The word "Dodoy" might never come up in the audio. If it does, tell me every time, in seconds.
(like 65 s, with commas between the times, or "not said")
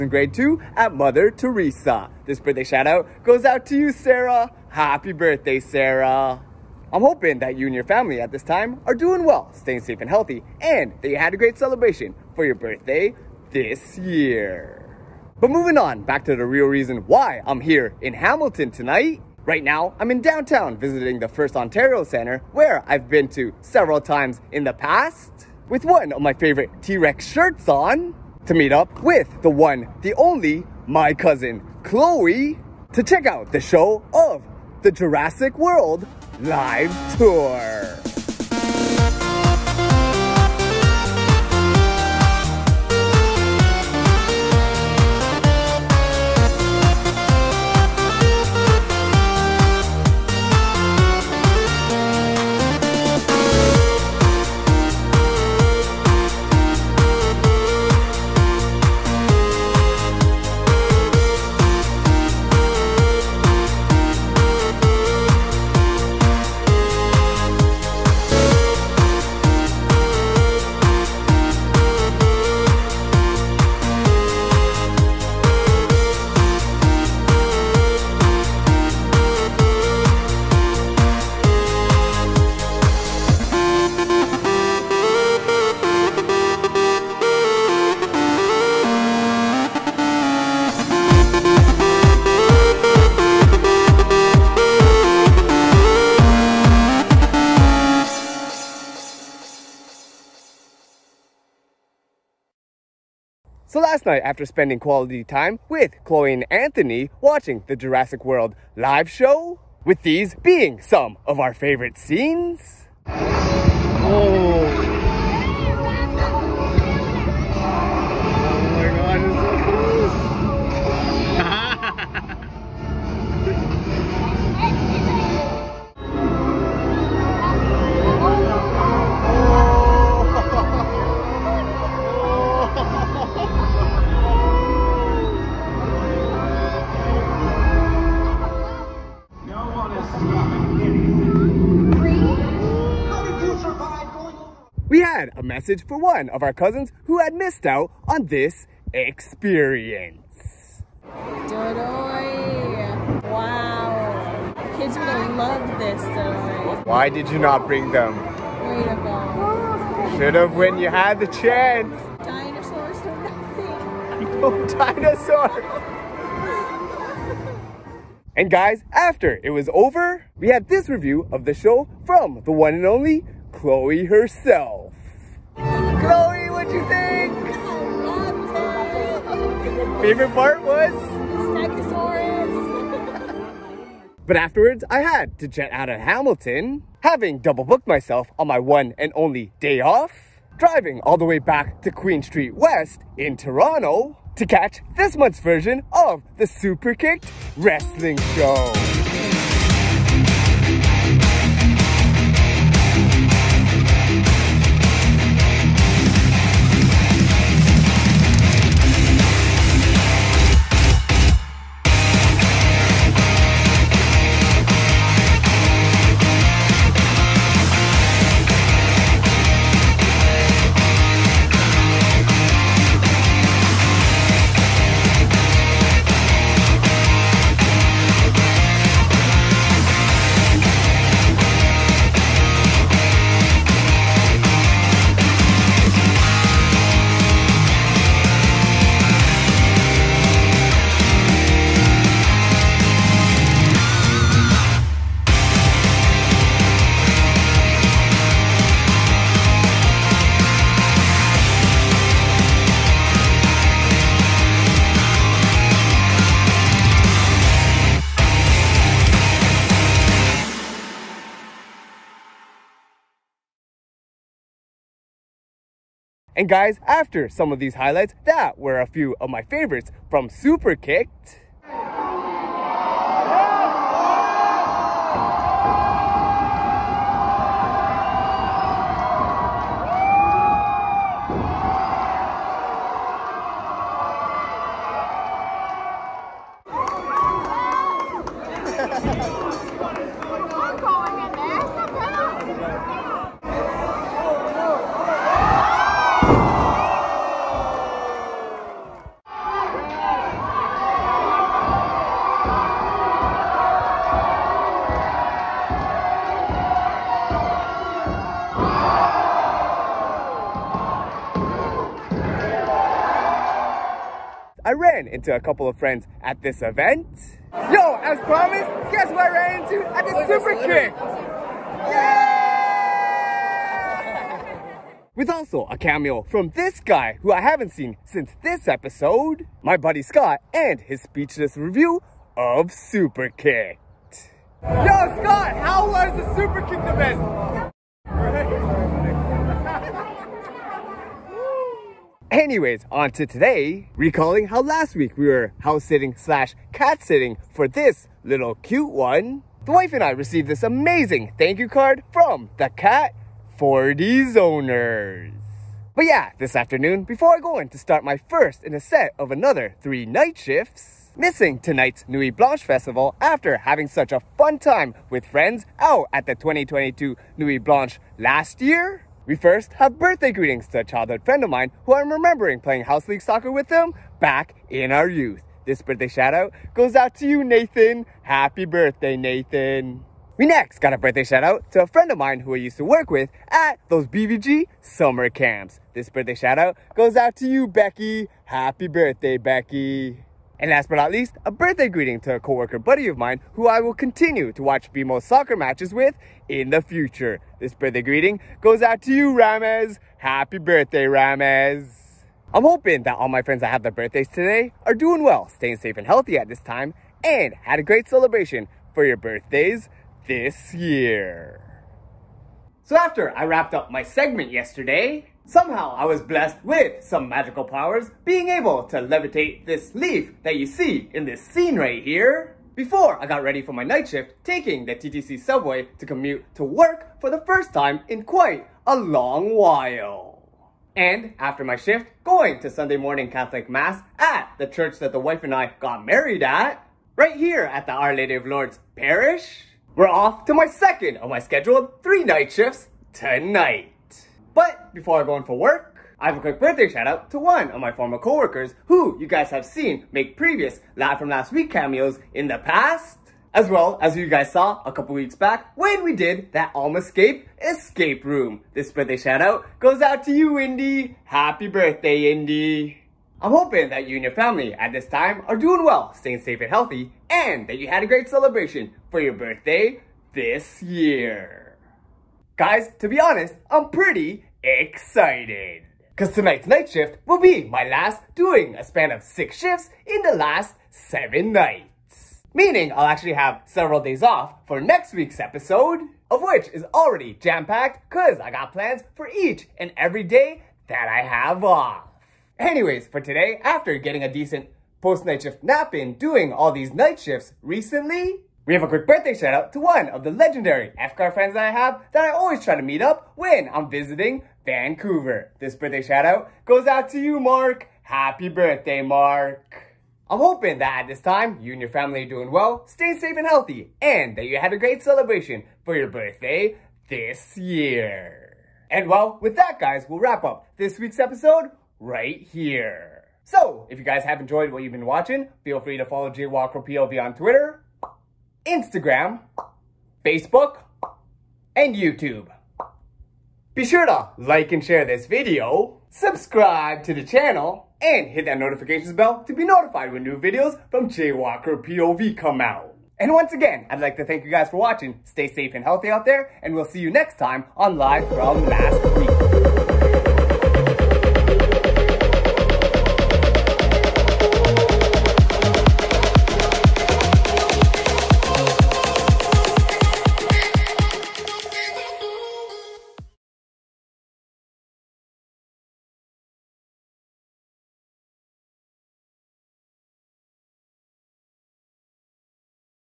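151 s, 156 s.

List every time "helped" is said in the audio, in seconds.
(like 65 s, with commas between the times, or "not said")
not said.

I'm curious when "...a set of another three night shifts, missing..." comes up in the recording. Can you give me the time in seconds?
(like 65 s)
358 s.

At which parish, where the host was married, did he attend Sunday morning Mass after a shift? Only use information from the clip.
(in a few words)
Our Lady of Lourdes Parish.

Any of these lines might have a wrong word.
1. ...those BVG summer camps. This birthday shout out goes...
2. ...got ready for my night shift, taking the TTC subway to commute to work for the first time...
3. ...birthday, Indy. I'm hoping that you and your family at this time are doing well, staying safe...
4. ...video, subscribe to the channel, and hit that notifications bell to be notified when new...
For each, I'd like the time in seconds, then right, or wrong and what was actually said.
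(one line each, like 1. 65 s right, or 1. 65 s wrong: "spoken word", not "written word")
1. 383 s right
2. 423 s right
3. 461 s right
4. 535 s right.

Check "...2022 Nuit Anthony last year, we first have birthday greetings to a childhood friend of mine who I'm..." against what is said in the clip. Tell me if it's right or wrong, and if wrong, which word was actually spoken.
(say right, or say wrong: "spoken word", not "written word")
wrong: "Blanche", not "Anthony".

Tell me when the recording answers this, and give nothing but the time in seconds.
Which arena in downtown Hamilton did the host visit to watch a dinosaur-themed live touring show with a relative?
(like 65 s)
21 s.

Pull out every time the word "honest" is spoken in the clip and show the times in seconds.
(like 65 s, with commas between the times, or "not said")
473 s.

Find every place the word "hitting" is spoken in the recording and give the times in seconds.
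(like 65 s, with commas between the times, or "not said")
not said.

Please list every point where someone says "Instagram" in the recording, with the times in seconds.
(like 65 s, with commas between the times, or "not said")
528 s.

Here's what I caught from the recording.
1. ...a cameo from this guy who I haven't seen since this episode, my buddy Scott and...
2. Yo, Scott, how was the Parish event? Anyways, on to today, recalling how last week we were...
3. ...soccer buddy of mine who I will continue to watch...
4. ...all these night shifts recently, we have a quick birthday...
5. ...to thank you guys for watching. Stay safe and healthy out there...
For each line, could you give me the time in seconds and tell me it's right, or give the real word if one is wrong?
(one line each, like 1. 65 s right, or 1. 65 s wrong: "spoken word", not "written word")
1. 325 s right
2. 334 s wrong: "Superkickd", not "Parish"
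3. 392 s wrong: "coworker", not "soccer"
4. 496 s right
5. 544 s right.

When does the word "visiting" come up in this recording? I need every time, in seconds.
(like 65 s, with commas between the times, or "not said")
20 s, 503 s.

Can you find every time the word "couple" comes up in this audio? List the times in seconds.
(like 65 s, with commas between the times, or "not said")
315 s, 454 s.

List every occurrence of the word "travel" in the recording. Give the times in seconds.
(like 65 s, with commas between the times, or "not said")
not said.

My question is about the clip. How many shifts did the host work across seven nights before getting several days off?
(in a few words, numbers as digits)
6.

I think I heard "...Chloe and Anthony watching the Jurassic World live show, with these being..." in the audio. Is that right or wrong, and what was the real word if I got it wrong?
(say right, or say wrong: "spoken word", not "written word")
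right.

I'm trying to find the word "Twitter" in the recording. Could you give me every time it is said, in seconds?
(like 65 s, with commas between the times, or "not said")
527 s.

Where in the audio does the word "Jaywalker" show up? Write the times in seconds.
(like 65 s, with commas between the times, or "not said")
526 s, 541 s.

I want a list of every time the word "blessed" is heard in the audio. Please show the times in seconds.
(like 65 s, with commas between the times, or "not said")
416 s.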